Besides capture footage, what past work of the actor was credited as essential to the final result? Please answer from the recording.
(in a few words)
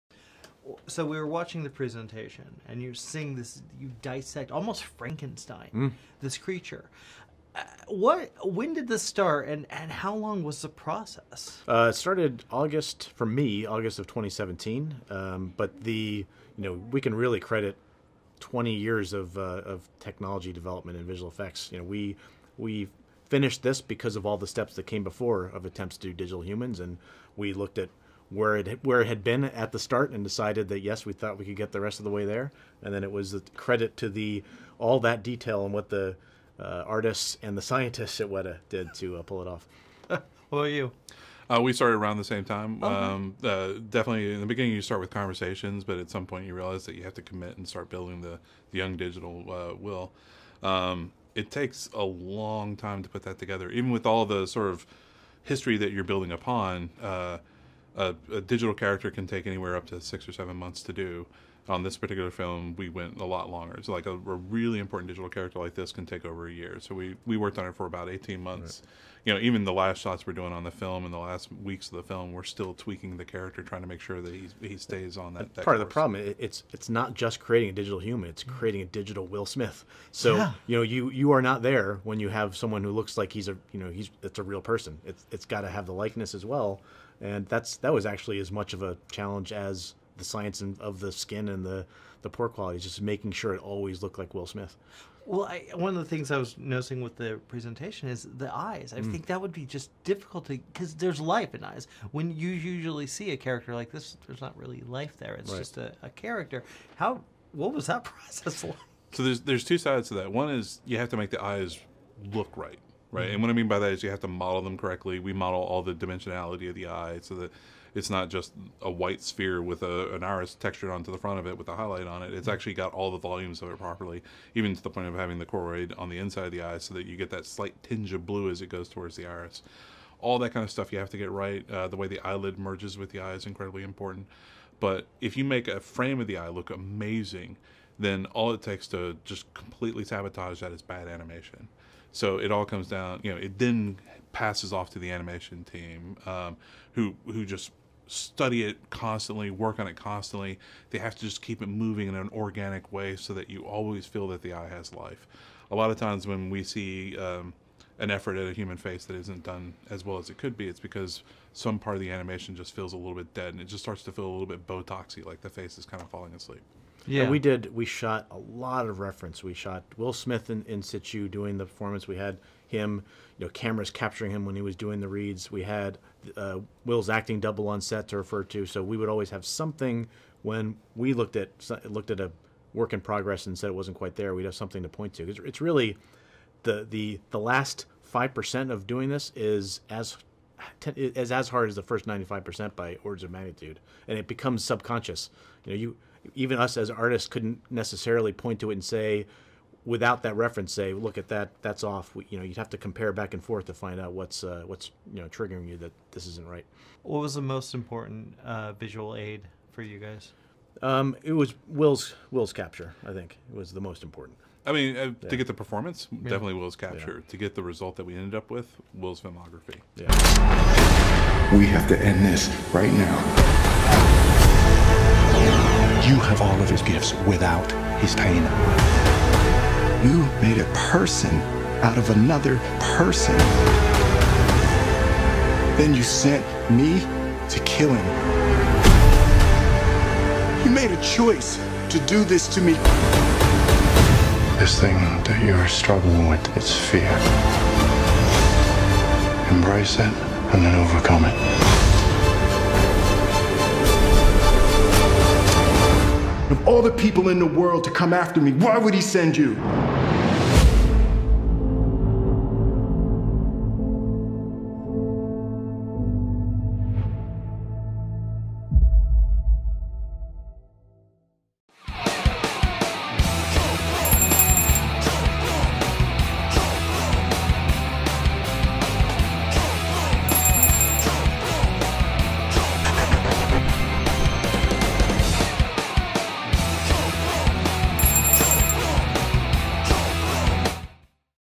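Will's filmography.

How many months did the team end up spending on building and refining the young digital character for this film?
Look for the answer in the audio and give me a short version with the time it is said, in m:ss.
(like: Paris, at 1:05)
18, at 1:08.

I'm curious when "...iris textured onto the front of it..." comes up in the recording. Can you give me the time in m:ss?
2:00.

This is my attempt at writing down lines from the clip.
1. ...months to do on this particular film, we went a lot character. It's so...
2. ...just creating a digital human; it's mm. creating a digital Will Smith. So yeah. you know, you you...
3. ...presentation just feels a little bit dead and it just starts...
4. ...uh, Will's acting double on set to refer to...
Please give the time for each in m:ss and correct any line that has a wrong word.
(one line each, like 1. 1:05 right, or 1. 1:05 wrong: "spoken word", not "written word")
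1. 1:00 wrong: "longer", not "character"
2. 1:17 right
3. 2:42 wrong: "animation", not "presentation"
4. 2:56 right.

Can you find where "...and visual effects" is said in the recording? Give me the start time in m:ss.
0:20.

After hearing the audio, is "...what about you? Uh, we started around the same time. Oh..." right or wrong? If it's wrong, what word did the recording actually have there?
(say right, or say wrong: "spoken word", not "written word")
right.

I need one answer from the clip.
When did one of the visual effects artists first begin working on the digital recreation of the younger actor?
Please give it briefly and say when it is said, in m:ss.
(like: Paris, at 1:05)
August 2017, at 0:13.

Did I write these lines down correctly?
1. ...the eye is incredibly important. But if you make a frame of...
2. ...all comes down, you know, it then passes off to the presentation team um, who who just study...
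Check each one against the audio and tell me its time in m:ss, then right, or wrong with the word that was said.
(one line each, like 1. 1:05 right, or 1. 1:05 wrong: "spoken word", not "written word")
1. 2:13 right
2. 2:22 wrong: "animation", not "presentation".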